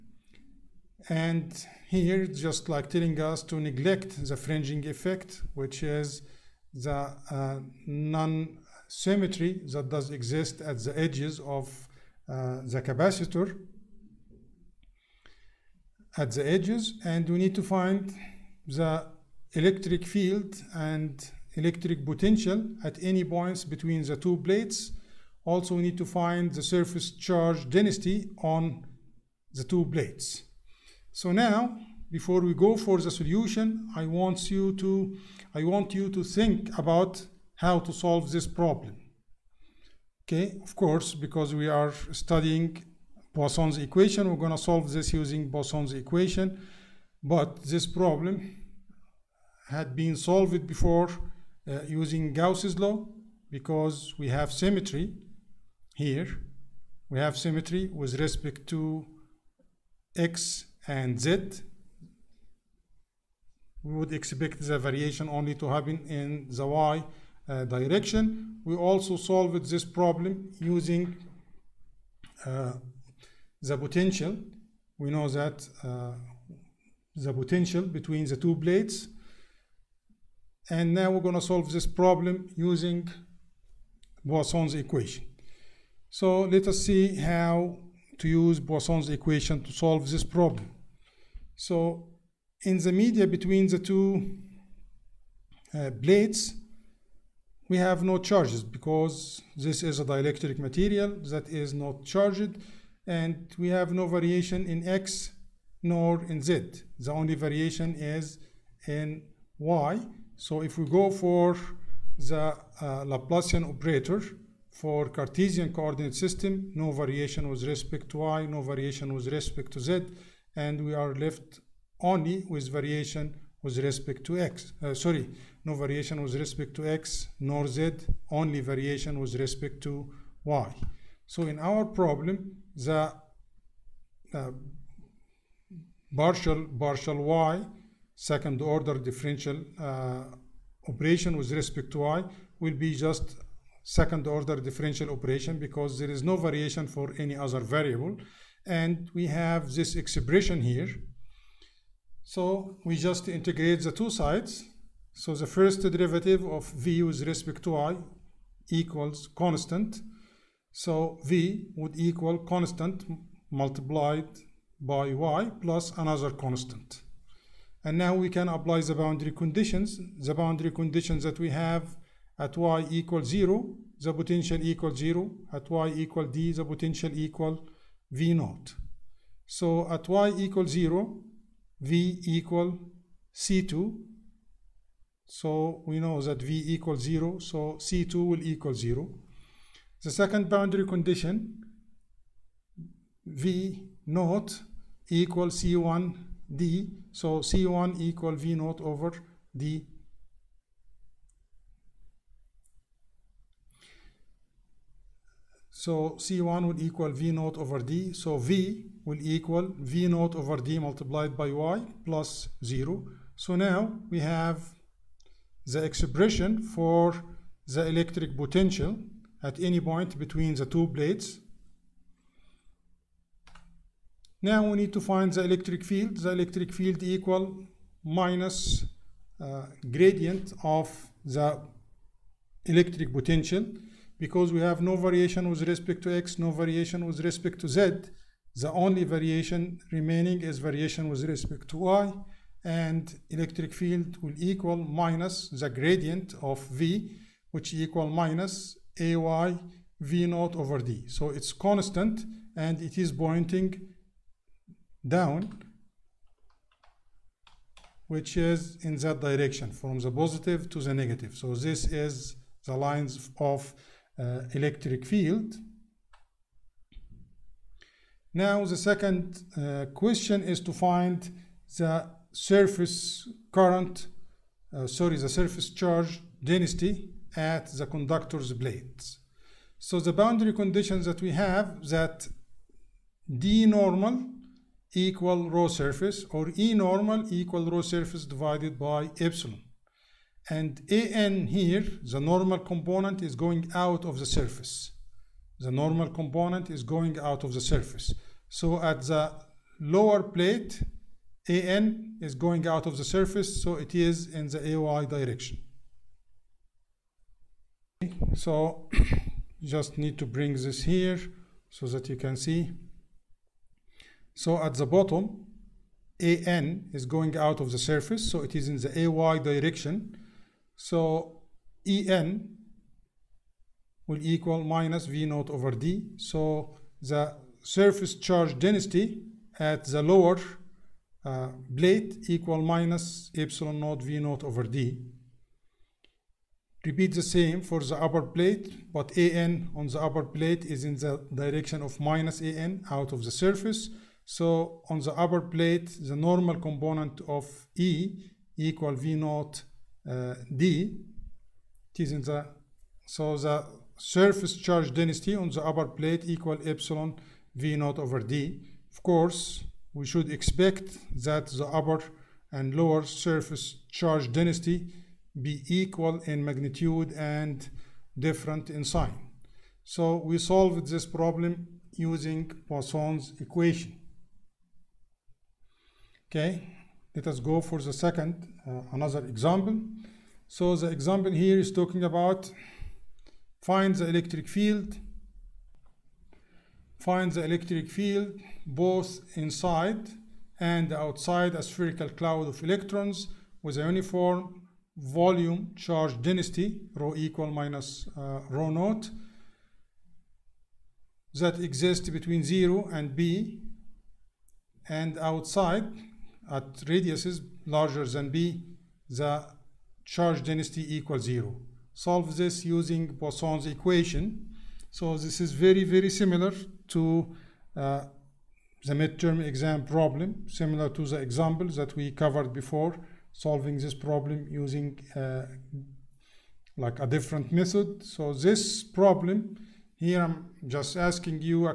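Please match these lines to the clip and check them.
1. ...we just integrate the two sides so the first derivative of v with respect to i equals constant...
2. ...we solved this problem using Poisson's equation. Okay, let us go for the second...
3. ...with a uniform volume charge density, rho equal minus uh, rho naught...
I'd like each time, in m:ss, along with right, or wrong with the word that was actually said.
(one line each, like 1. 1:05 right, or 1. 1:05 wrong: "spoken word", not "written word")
1. 2:32 right
2. 6:10 right
3. 6:33 right.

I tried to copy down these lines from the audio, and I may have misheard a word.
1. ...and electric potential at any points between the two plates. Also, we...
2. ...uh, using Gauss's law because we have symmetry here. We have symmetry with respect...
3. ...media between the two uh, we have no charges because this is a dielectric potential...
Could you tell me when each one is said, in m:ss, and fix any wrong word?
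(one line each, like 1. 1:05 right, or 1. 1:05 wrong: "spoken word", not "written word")
1. 0:20 right
2. 0:51 right
3. 1:32 wrong: "material", not "potential".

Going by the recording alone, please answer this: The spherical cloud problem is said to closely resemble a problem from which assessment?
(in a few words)
Midterm exam.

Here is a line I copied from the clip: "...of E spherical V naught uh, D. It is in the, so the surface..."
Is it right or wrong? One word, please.
wrong.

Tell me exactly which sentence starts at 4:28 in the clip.
Now the second uh, question is to find the surface current, uh, sorry, the surface charge density at the conductor's blades.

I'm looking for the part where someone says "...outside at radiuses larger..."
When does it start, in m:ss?
6:45.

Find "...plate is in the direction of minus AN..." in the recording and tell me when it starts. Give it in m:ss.
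5:40.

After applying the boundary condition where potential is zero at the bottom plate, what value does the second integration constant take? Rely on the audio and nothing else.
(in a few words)
0.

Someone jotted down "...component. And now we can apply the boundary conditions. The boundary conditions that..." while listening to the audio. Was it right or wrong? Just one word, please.
wrong.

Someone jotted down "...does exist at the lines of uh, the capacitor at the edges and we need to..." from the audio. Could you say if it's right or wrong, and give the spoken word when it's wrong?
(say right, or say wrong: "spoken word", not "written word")
wrong: "edges", not "lines".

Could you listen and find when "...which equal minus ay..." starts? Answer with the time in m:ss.
4:07.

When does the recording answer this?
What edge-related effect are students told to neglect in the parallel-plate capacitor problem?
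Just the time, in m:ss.
0:04.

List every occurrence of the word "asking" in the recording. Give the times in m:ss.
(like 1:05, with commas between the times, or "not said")
7:10.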